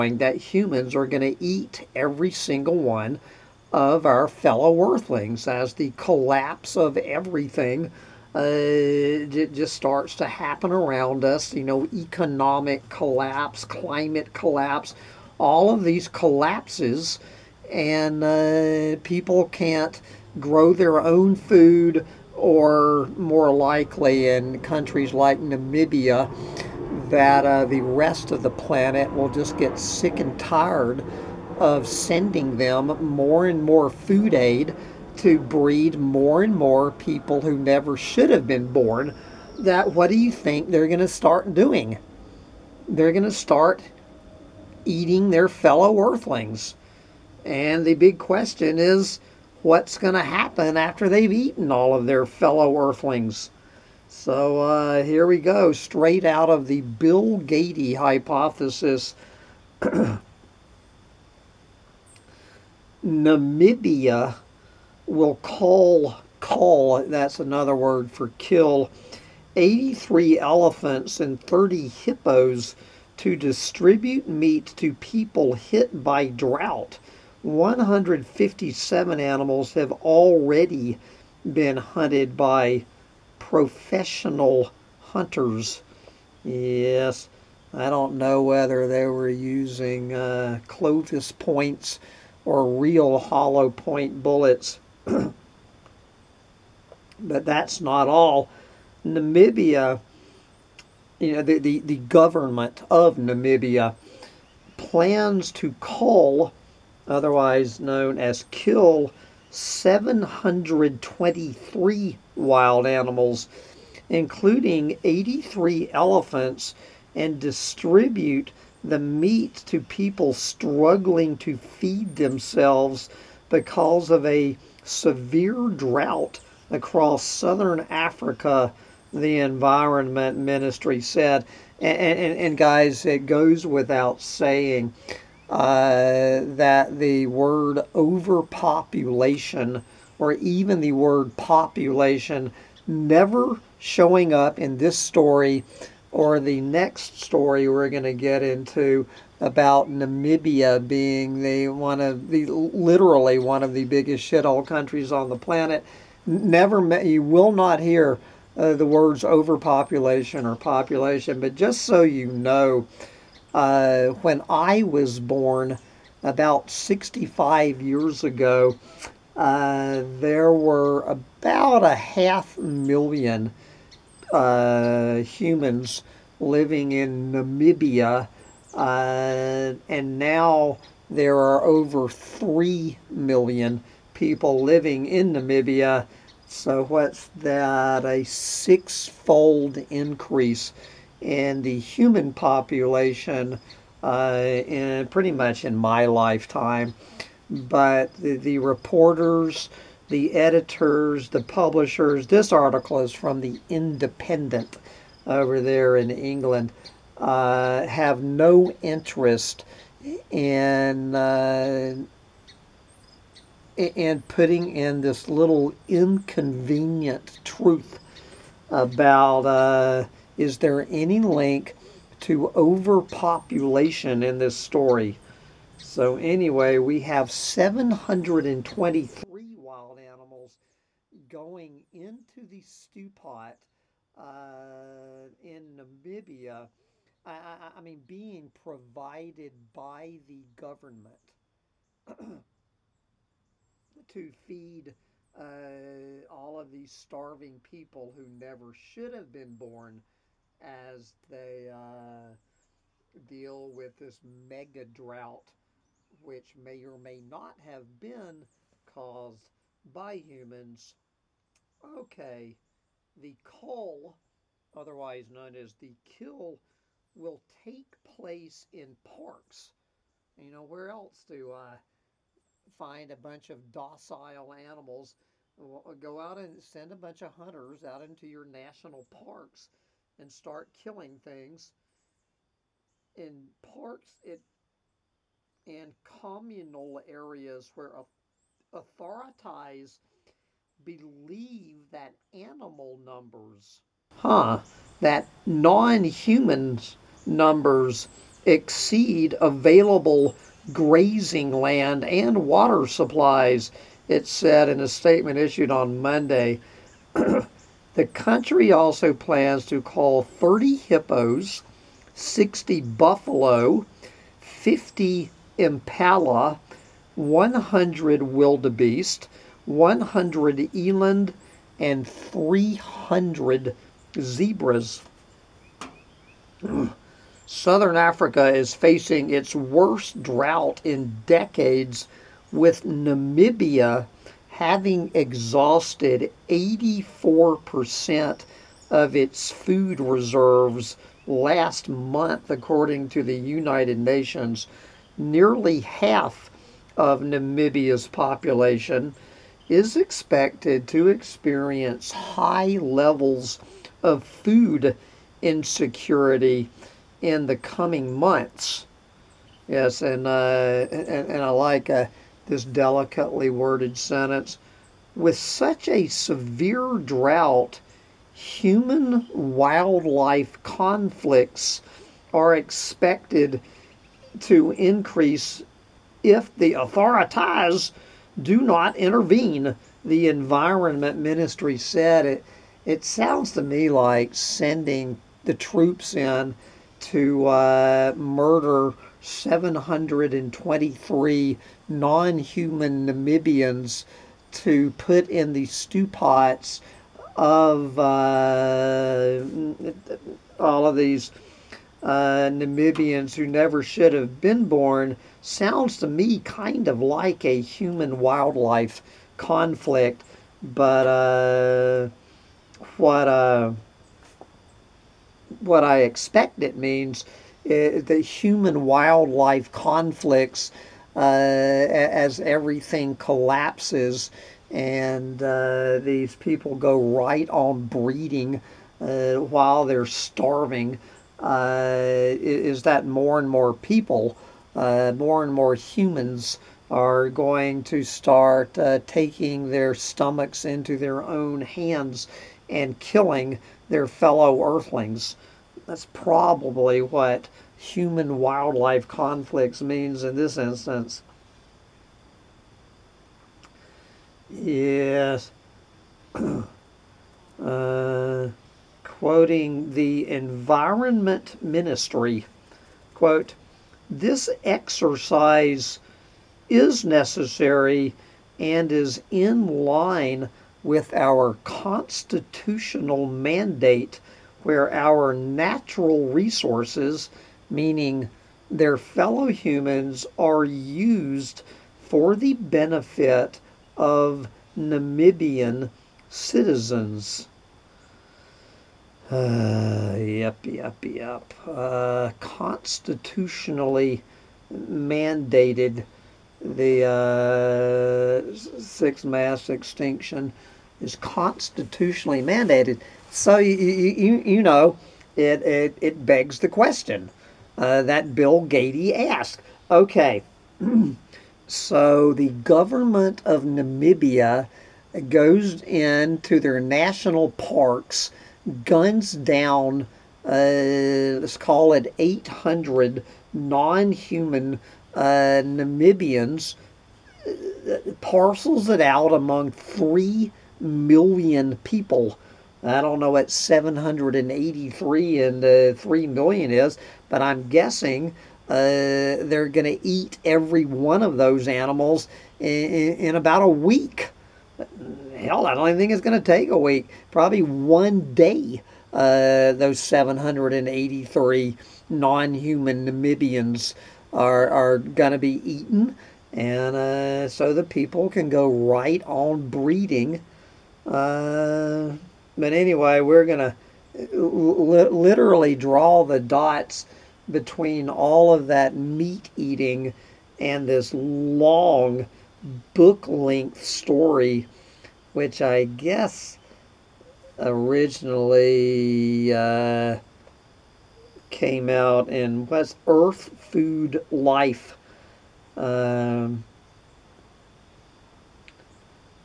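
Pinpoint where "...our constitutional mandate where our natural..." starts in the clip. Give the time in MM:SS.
07:51.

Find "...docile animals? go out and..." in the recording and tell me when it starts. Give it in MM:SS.
04:33.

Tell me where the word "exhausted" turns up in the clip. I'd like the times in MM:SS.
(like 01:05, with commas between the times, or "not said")
05:35.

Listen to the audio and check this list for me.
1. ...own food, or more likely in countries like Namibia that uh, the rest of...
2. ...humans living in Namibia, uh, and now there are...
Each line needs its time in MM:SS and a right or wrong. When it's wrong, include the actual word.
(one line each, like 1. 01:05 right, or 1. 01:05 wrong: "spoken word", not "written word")
1. 00:21 right
2. 02:55 right.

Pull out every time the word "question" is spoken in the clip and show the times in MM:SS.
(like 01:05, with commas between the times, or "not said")
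00:48, 08:26.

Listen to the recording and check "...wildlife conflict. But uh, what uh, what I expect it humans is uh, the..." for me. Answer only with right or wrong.
wrong.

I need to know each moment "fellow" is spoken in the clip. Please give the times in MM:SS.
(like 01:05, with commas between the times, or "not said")
00:04, 00:45, 00:52, 07:24, 07:58.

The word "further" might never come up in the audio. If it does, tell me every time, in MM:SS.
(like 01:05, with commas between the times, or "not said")
not said.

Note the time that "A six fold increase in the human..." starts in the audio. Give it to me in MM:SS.
03:08.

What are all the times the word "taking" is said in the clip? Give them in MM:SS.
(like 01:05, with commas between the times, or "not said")
07:19.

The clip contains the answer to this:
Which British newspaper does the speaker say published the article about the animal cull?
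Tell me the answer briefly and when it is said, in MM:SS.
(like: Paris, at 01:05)
The Independent, at 03:23.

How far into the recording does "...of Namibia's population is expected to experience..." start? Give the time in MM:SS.
05:46.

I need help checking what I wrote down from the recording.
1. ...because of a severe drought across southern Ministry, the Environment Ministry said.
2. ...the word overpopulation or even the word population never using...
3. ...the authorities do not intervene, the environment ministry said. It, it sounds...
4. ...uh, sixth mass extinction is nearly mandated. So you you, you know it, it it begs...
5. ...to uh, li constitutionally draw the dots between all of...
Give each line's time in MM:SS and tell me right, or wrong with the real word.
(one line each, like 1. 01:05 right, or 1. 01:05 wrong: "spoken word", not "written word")
1. 02:03 wrong: "Africa", not "Ministry"
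2. 02:16 wrong: "showing", not "using"
3. 06:16 right
4. 08:18 wrong: "constitutionally", not "nearly"
5. 09:23 wrong: "literally", not "constitutionally".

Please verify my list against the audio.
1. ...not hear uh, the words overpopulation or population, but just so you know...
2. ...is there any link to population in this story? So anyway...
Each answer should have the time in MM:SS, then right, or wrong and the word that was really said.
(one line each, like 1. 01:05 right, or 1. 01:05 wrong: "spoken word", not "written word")
1. 02:37 right
2. 03:40 wrong: "overpopulation", not "population".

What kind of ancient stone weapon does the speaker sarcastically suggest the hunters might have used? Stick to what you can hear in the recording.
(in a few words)
Clovis points.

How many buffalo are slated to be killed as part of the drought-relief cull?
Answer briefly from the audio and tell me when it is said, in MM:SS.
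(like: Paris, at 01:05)
60, at 05:12.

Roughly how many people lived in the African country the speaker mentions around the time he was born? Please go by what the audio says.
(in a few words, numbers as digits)
half million.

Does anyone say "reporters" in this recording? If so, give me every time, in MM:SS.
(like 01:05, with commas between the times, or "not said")
03:18.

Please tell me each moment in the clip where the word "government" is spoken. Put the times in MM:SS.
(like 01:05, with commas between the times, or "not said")
01:41, 04:00, 08:32.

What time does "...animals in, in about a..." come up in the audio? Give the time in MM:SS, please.
09:01.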